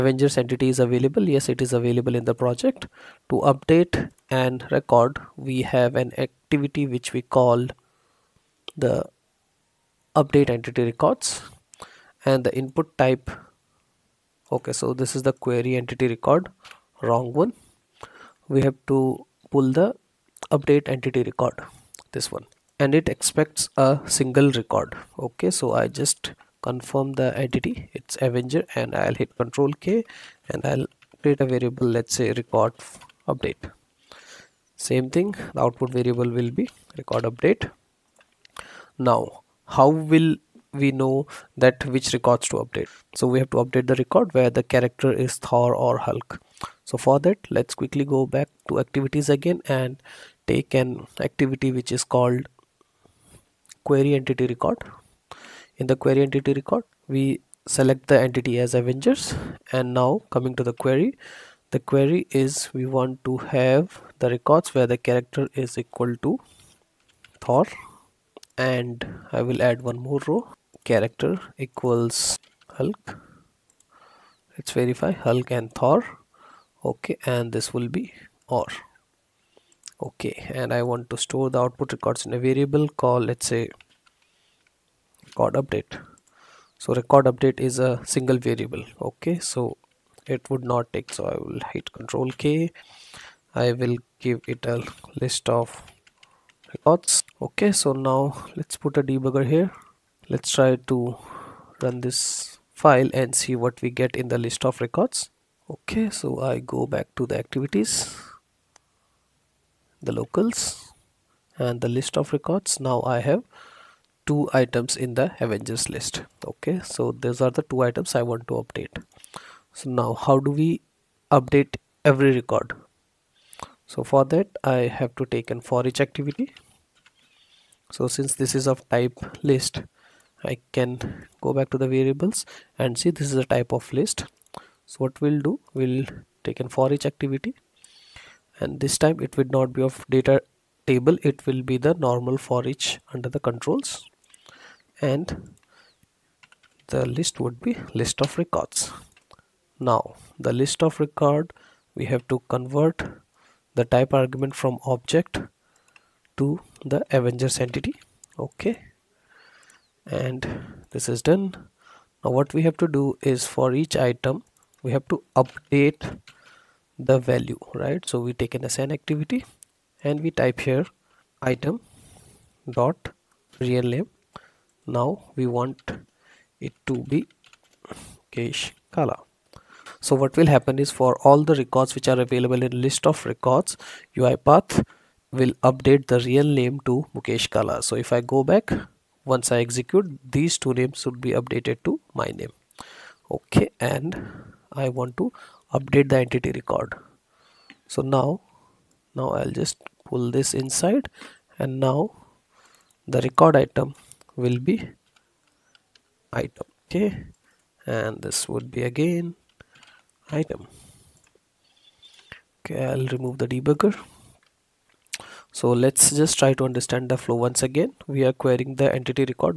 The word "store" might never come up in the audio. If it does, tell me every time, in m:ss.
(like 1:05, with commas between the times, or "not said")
1:21.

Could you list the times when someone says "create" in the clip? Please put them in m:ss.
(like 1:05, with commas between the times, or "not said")
0:31.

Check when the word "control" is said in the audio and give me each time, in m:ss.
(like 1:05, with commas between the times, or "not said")
0:29, 1:31, 2:23.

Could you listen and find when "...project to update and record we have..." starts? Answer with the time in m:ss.
0:02.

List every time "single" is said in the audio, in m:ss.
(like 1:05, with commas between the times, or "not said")
0:24, 1:28.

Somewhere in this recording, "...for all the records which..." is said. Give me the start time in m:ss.
3:00.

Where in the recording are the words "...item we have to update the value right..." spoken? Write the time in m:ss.
2:43.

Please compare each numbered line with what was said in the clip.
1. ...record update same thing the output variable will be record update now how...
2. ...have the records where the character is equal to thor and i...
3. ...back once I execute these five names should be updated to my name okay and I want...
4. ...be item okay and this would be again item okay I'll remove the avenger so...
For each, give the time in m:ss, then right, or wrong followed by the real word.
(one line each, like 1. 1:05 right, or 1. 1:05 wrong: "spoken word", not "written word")
1. 0:32 right
2. 1:03 right
3. 3:08 wrong: "two", not "five"
4. 3:24 wrong: "debugger", not "avenger".